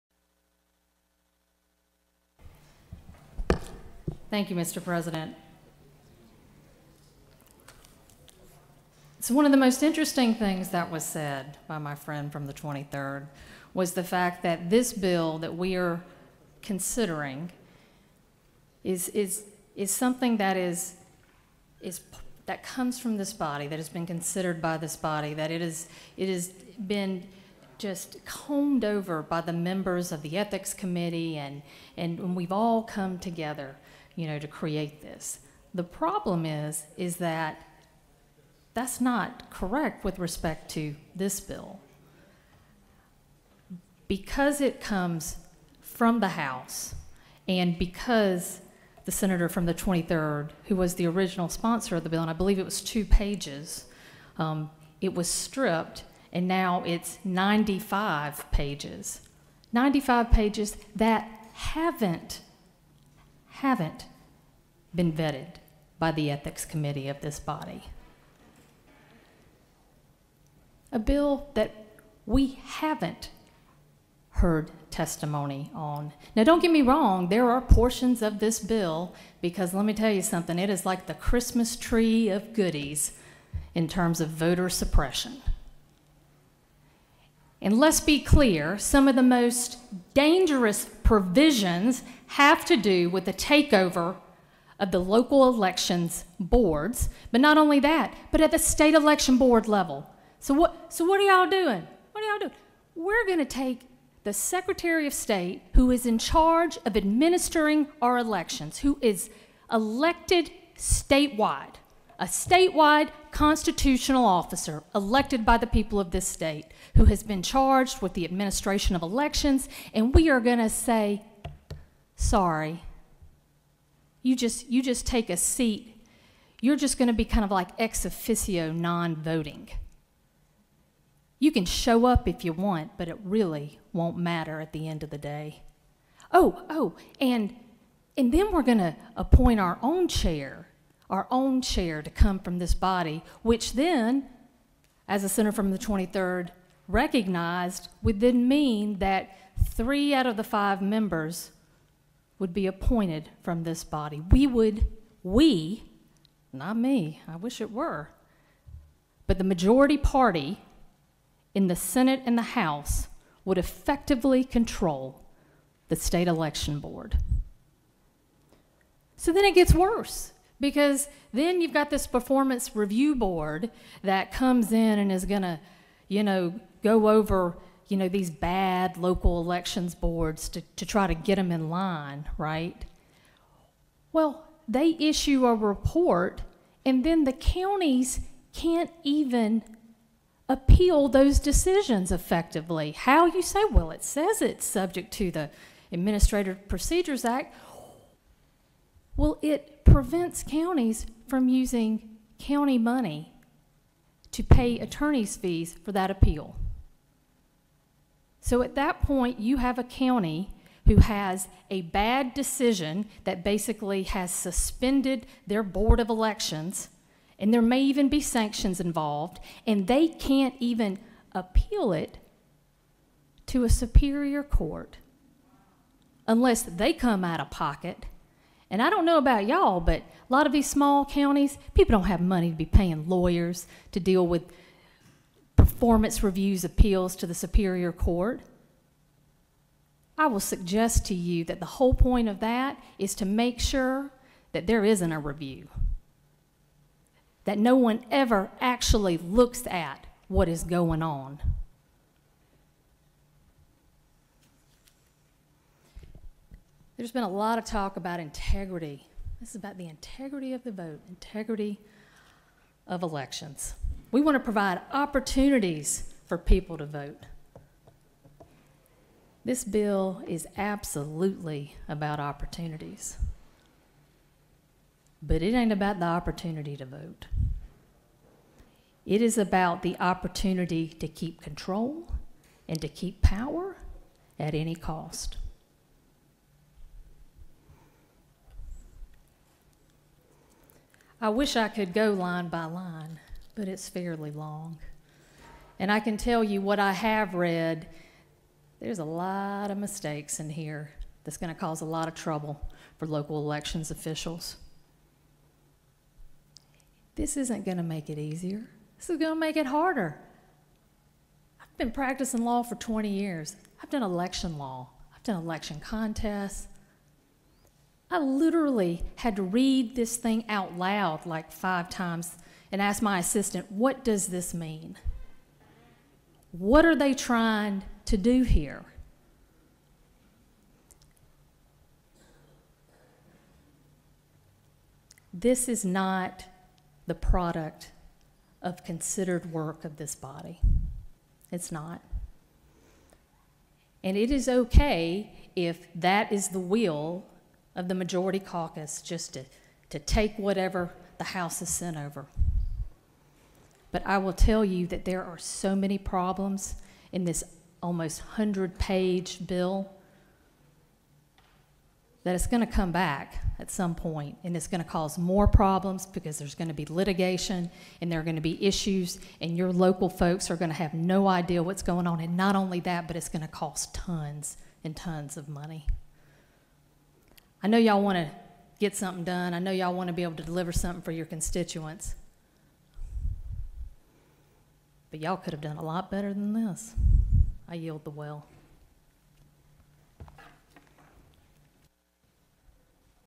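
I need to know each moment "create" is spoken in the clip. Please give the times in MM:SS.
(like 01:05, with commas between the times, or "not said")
00:34.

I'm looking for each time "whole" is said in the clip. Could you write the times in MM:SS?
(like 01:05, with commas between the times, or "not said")
04:01.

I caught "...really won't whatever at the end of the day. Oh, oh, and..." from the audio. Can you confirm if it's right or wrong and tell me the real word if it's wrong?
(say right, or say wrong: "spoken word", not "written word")
wrong: "matter", not "whatever".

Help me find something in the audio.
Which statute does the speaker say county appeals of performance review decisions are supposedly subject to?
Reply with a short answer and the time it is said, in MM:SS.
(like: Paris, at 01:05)
Administrative Procedures Act, at 03:15.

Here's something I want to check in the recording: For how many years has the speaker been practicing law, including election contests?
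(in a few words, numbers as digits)
20.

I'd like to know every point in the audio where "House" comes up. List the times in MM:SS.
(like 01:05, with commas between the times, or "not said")
00:46, 02:42, 05:51.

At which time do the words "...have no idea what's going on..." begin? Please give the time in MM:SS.
06:10.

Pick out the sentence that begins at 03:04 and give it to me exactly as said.
Well, they issue a report, and then the counties can't even appeal those decisions effectively.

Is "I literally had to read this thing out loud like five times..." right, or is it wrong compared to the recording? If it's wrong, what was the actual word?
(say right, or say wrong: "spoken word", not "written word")
right.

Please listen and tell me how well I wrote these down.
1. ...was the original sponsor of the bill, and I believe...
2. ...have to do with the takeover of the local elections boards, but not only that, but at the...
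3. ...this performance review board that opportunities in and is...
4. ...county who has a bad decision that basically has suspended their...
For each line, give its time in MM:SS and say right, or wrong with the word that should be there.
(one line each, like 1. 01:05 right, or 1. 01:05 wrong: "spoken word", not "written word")
1. 00:50 right
2. 01:32 right
3. 02:51 wrong: "comes", not "opportunities"
4. 03:29 right.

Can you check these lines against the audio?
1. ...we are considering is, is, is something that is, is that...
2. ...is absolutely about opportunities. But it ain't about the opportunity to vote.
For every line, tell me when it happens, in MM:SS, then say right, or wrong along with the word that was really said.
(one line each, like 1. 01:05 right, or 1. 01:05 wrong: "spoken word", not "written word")
1. 00:15 right
2. 04:30 right.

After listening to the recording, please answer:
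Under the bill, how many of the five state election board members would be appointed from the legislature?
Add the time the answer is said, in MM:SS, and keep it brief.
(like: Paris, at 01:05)
3, at 02:29.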